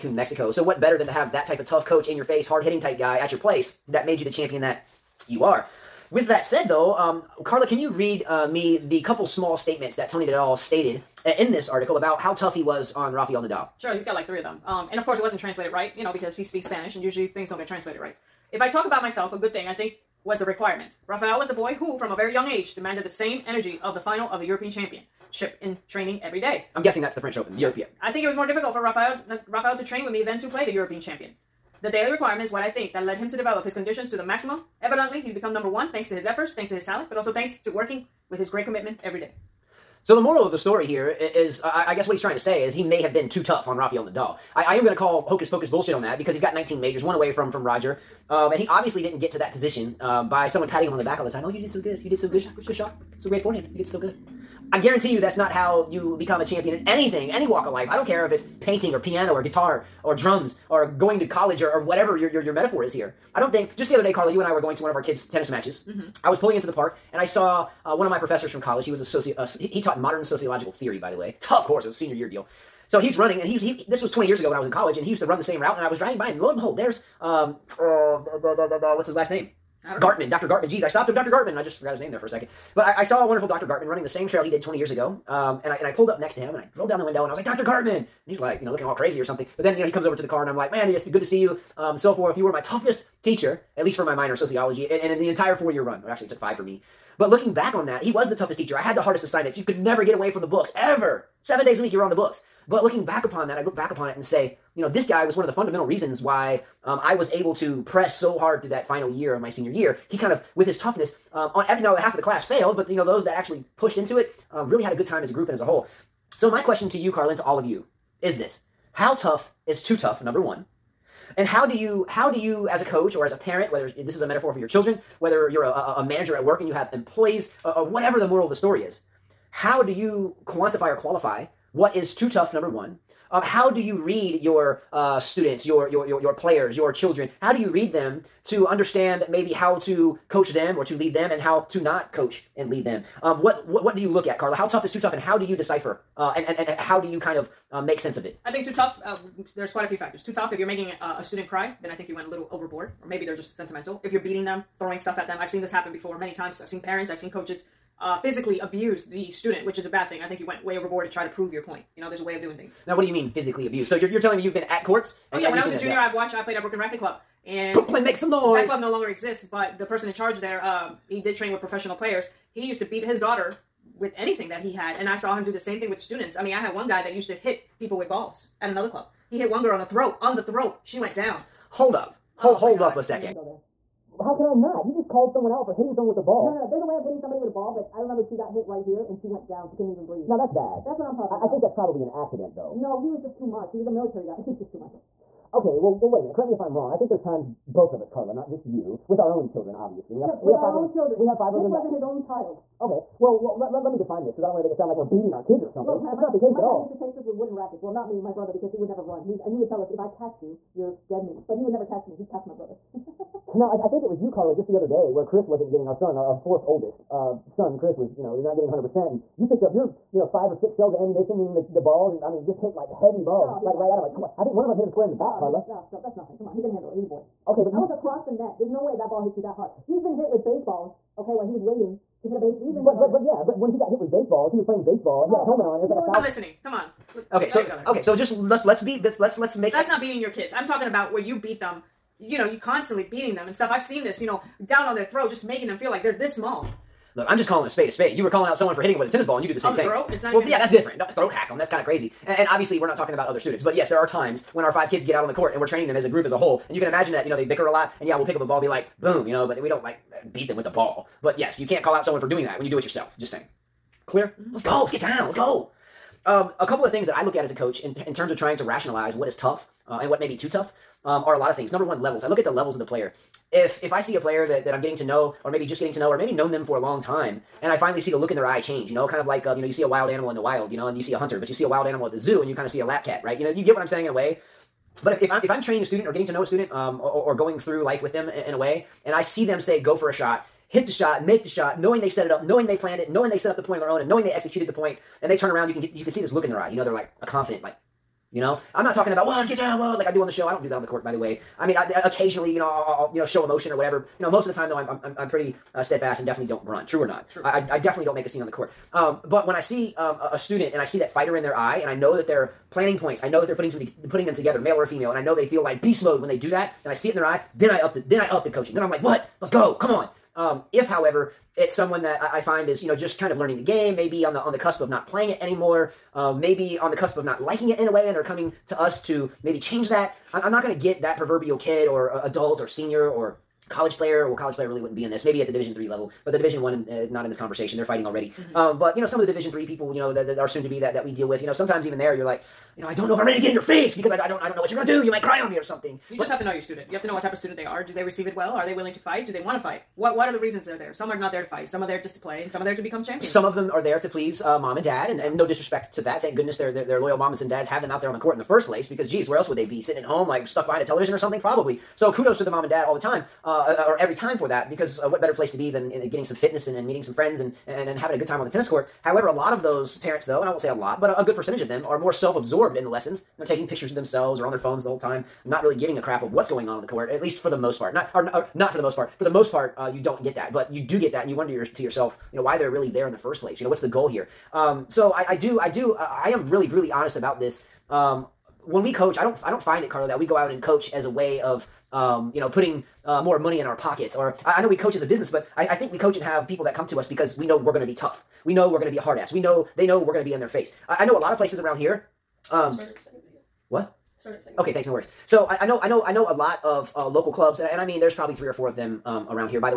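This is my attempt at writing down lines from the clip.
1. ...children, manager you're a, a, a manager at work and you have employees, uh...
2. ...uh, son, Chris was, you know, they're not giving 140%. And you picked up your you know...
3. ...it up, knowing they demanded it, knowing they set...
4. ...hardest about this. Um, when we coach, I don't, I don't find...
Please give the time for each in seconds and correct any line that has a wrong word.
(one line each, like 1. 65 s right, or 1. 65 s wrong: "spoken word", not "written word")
1. 124 s wrong: "whether", not "manager"
2. 217 s wrong: "100", not "140"
3. 292 s wrong: "planned", not "demanded"
4. 386 s wrong: "honest", not "hardest".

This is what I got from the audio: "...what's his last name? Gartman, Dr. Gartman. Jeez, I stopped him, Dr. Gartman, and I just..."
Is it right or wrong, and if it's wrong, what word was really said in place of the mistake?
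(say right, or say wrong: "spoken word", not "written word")
right.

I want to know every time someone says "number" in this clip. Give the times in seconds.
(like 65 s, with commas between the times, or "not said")
35 s, 120 s, 132 s, 271 s.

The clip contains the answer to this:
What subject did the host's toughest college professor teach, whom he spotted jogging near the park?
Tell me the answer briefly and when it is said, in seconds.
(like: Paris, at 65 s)
modern sociological theory, at 69 s.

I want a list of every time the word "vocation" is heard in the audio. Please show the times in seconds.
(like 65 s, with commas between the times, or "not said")
not said.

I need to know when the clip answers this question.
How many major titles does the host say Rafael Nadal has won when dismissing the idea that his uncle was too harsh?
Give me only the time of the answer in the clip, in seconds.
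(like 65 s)
46 s.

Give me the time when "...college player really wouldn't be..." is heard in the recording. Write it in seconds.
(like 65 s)
334 s.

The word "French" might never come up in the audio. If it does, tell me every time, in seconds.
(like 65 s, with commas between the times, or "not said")
27 s.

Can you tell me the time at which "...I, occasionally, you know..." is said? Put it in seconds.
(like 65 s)
301 s.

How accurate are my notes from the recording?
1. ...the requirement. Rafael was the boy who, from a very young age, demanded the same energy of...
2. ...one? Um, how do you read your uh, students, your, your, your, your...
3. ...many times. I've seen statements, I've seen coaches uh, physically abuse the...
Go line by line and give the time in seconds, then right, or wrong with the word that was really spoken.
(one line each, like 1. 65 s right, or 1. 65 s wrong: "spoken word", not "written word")
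1. 20 s right
2. 132 s right
3. 156 s wrong: "parents", not "statements".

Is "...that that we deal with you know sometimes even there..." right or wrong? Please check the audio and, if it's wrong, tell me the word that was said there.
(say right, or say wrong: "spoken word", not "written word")
right.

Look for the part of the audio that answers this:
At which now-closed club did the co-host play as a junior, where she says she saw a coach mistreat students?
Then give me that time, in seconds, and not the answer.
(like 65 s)
166 s.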